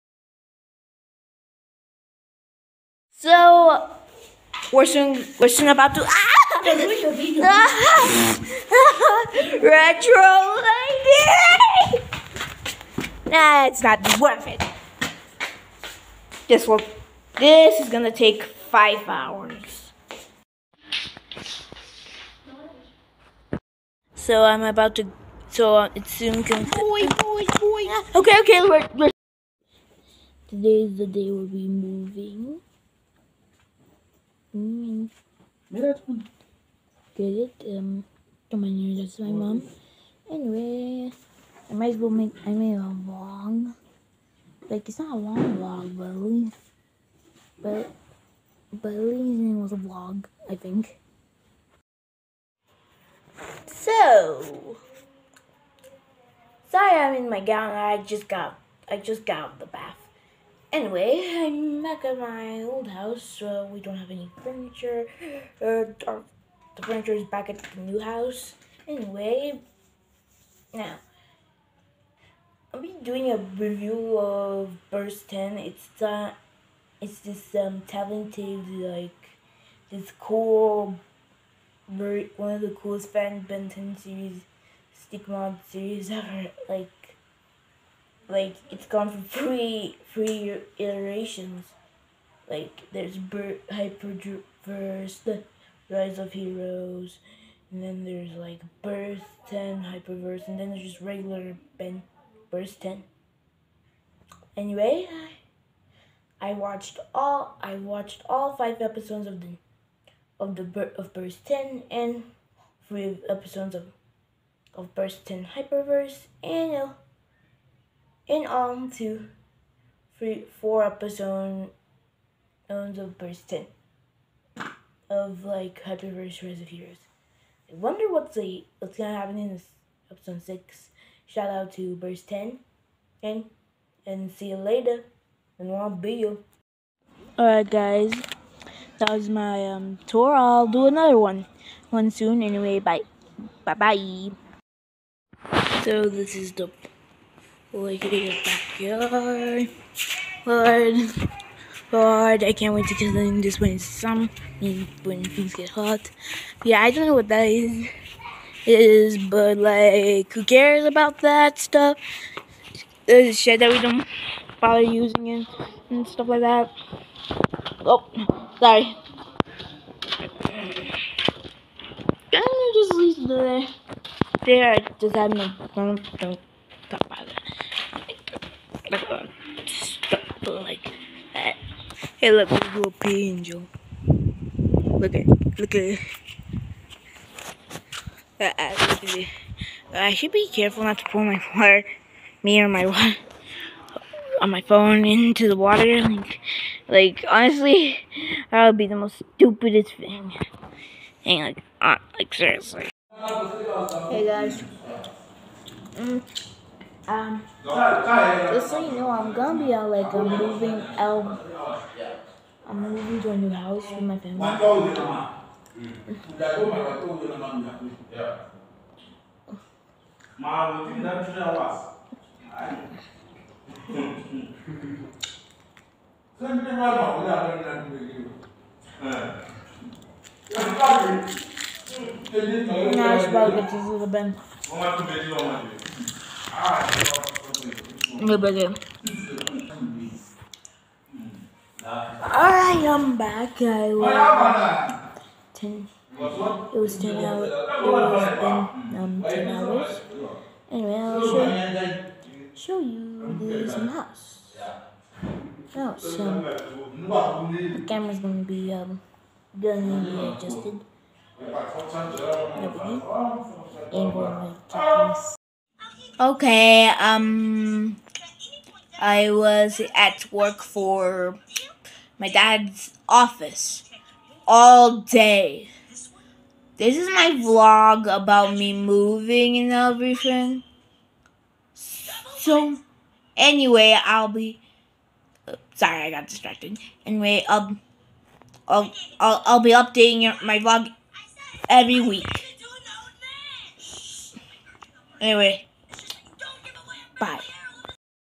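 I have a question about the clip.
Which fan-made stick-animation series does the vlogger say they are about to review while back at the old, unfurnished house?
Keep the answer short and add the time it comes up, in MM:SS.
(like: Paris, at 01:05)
Birst 10, at 01:14.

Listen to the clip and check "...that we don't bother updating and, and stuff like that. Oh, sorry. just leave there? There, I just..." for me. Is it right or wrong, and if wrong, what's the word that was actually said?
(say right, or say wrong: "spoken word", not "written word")
wrong: "using", not "updating".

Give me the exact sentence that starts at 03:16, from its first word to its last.
Like, like honestly, that would be the most stupidest thing.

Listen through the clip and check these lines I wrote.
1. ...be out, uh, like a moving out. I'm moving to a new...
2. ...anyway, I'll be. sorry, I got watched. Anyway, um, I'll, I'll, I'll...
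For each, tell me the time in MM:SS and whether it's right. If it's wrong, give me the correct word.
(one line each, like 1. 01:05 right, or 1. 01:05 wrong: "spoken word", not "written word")
1. 03:29 right
2. 04:43 wrong: "distracted", not "watched".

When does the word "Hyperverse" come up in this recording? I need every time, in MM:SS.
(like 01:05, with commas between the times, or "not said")
01:33, 01:39, 01:55, 02:05.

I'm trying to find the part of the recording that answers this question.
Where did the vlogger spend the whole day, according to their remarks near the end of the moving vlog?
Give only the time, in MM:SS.
04:32.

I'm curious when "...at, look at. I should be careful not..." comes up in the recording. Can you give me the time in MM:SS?
03:05.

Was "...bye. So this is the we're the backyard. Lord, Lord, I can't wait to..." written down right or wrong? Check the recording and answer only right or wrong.
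right.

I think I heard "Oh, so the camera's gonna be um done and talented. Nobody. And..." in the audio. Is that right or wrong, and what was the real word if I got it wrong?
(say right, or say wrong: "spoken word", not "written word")
wrong: "adjusted", not "talented".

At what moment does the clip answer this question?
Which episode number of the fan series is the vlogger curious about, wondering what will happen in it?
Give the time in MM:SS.
02:10.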